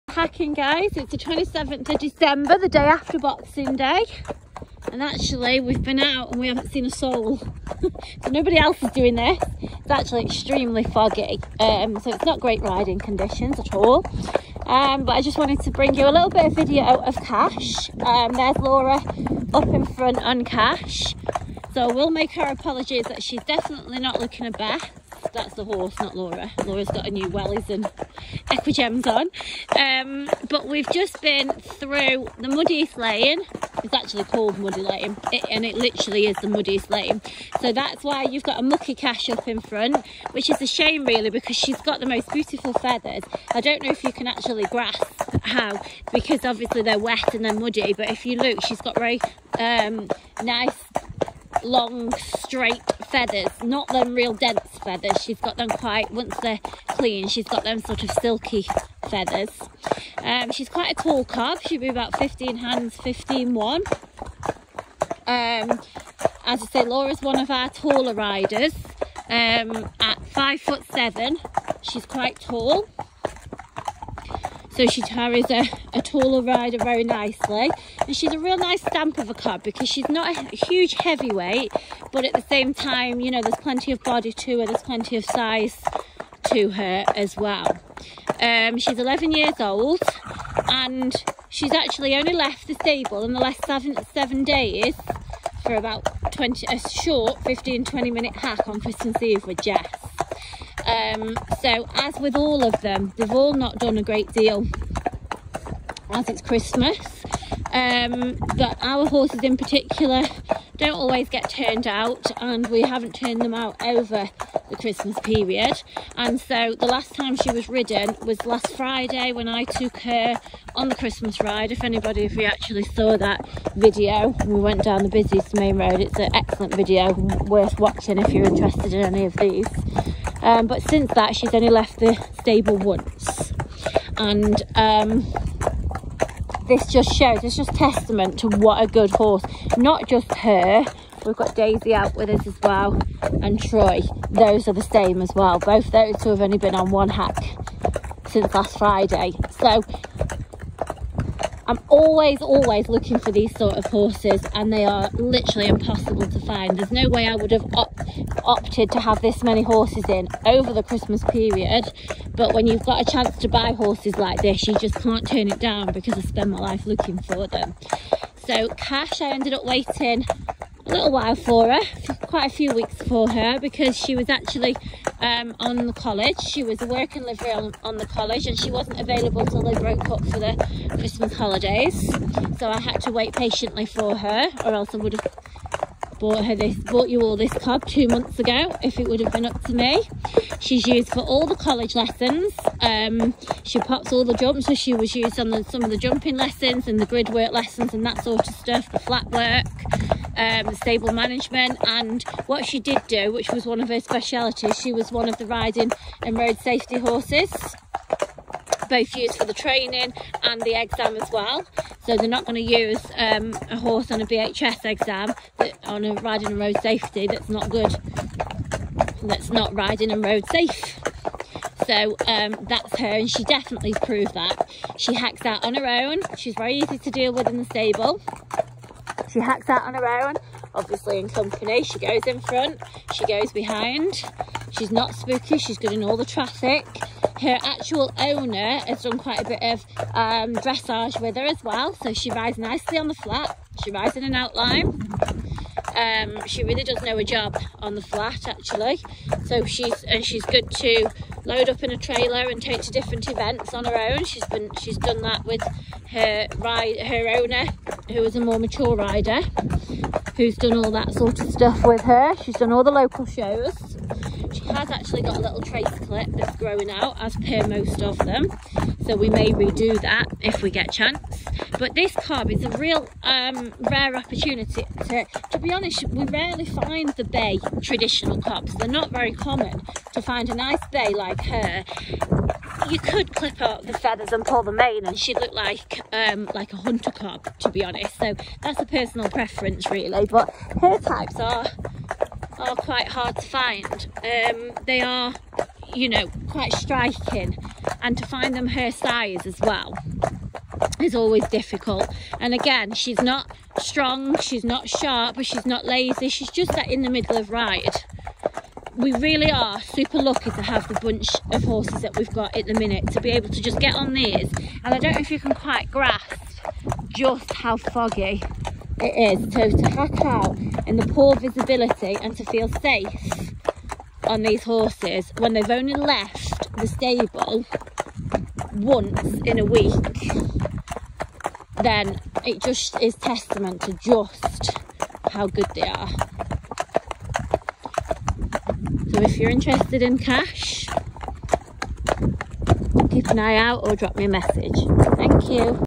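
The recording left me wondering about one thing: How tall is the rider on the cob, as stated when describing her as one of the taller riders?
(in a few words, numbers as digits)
5 foot 7.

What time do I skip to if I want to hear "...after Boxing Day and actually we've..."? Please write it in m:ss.
0:02.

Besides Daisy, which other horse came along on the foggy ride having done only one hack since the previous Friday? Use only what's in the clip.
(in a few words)
Troy.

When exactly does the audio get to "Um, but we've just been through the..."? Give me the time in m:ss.
0:29.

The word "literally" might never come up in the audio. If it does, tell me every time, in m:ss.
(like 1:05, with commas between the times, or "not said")
0:35, 2:35.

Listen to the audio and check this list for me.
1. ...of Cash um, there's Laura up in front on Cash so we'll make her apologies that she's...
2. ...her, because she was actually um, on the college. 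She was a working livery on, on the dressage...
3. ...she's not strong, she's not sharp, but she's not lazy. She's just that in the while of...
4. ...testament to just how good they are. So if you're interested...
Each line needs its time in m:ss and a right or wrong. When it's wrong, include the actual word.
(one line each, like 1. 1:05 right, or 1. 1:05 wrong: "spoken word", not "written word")
1. 0:17 right
2. 2:53 wrong: "college", not "dressage"
3. 5:02 wrong: "middle", not "while"
4. 5:33 right.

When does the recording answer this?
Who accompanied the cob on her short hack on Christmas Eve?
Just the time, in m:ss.
1:39.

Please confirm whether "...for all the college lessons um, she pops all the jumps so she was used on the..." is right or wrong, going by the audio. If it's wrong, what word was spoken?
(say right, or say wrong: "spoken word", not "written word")
right.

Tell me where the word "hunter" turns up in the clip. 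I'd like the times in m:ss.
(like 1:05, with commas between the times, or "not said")
4:46.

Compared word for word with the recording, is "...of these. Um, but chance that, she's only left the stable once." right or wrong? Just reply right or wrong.
wrong.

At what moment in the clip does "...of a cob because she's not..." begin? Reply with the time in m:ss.
1:19.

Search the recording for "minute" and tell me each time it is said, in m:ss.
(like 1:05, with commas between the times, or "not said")
1:38, 5:12.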